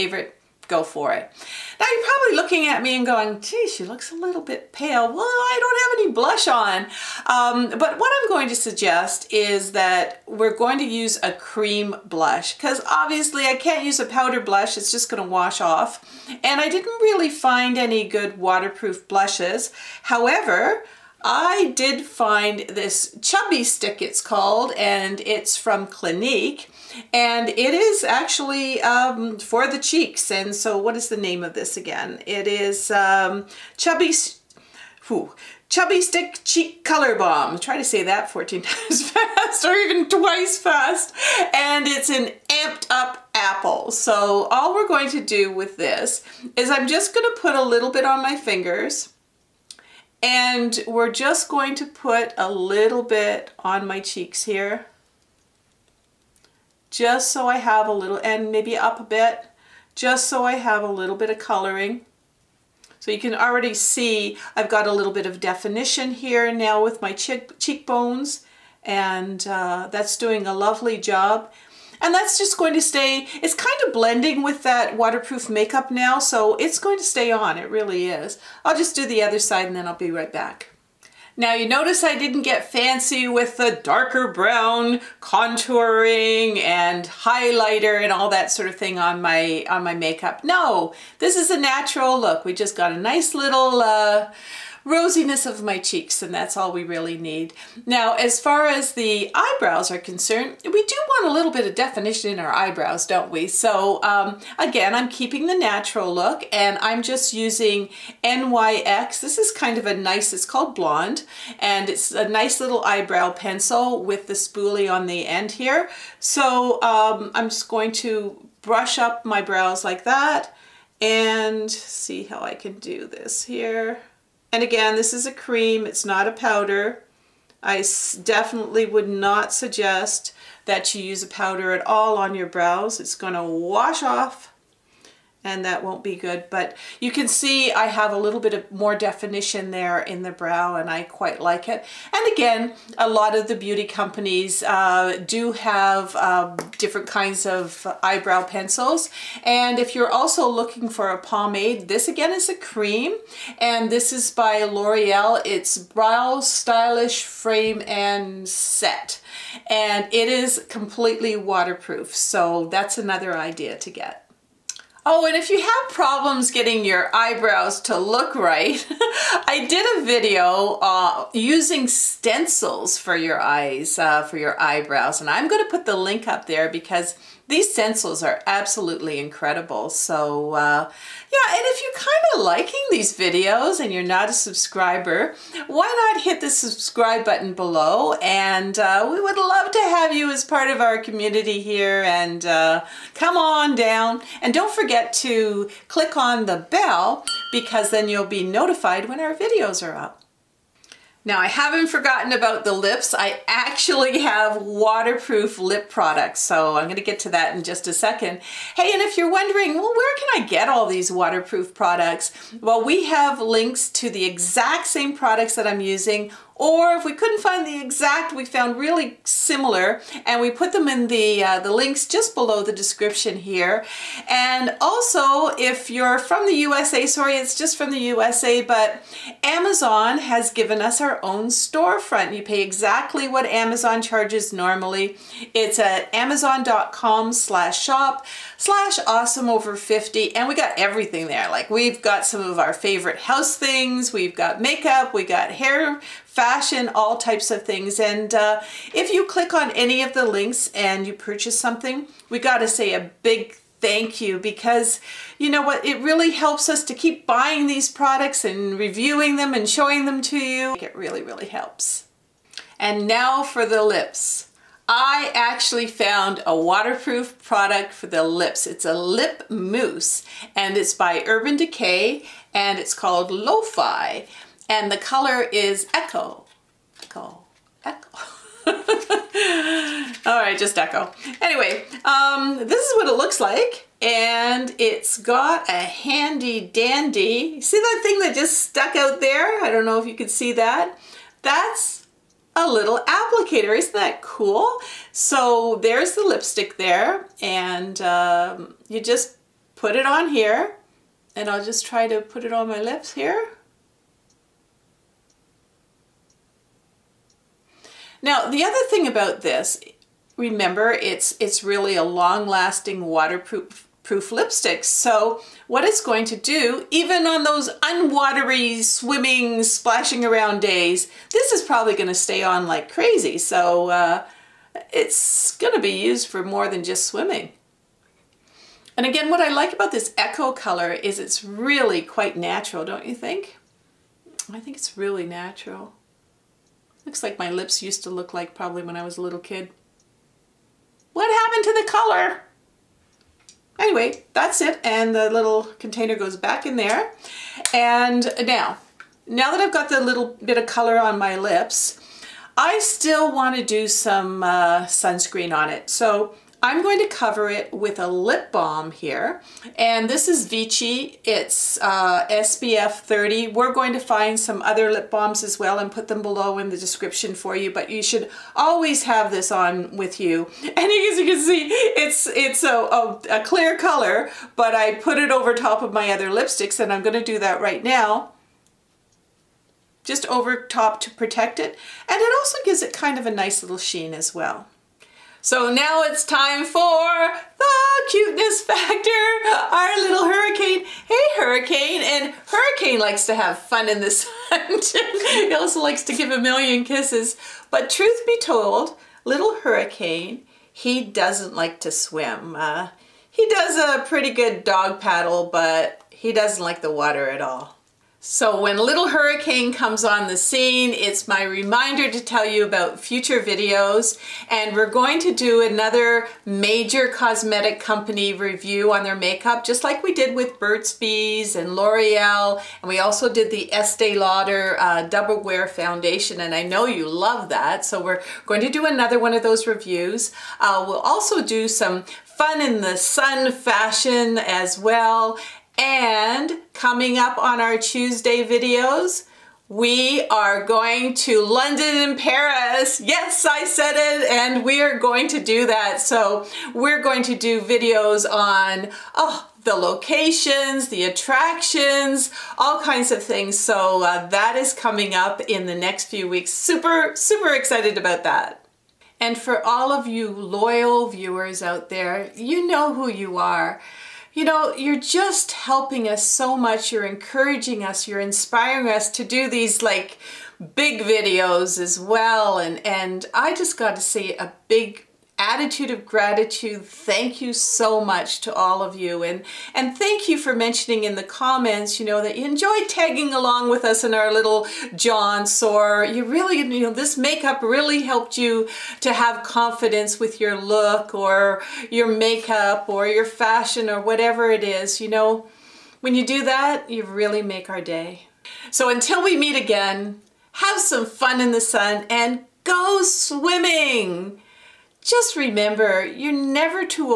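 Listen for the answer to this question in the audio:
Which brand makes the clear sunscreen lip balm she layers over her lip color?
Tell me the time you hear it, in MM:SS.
06:00.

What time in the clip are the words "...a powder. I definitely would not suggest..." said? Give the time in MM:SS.
02:06.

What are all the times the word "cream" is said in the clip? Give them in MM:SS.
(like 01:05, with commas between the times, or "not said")
00:11, 02:05, 02:32.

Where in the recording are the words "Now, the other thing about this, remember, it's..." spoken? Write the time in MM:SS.
05:08.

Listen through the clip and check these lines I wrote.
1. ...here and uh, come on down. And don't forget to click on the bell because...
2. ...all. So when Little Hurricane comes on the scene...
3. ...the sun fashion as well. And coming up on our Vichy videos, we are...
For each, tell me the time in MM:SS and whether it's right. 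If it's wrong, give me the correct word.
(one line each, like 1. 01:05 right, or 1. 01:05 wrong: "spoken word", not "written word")
1. 03:11 right
2. 06:47 right
3. 07:12 wrong: "Tuesday", not "Vichy".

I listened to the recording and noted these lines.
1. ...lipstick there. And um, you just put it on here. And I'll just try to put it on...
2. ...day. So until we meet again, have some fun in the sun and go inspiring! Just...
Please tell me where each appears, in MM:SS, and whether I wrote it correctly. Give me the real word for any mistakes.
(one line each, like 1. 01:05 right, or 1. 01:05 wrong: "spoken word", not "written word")
1. 04:56 right
2. 08:17 wrong: "swimming", not "inspiring".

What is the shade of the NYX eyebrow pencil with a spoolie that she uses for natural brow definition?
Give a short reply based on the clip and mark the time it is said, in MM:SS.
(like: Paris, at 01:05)
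Blonde, at 01:50.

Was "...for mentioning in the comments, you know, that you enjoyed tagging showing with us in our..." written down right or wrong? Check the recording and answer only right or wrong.
wrong.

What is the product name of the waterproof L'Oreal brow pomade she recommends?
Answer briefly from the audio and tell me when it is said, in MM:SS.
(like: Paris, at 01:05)
Brow Stylist Frame and Set, at 02:35.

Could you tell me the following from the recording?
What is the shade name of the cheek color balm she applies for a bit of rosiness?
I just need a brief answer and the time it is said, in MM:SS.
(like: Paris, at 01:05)
Amped Up Apple, at 00:42.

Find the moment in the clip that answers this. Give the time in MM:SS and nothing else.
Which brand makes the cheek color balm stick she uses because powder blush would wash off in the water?
00:25.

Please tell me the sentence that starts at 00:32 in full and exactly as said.
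It is um, chubby whew, Chubby Stick Cheek Color Balm.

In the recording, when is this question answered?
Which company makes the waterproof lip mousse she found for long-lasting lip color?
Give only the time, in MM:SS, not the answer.
04:31.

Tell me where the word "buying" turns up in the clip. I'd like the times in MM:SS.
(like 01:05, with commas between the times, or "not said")
04:17.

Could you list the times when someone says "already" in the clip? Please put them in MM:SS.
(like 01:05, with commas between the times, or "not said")
01:03.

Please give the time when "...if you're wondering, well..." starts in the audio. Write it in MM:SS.
03:29.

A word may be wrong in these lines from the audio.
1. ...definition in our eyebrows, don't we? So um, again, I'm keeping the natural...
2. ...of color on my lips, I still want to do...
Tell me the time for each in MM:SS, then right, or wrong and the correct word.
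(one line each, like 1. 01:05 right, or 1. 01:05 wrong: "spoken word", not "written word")
1. 01:41 right
2. 05:50 right.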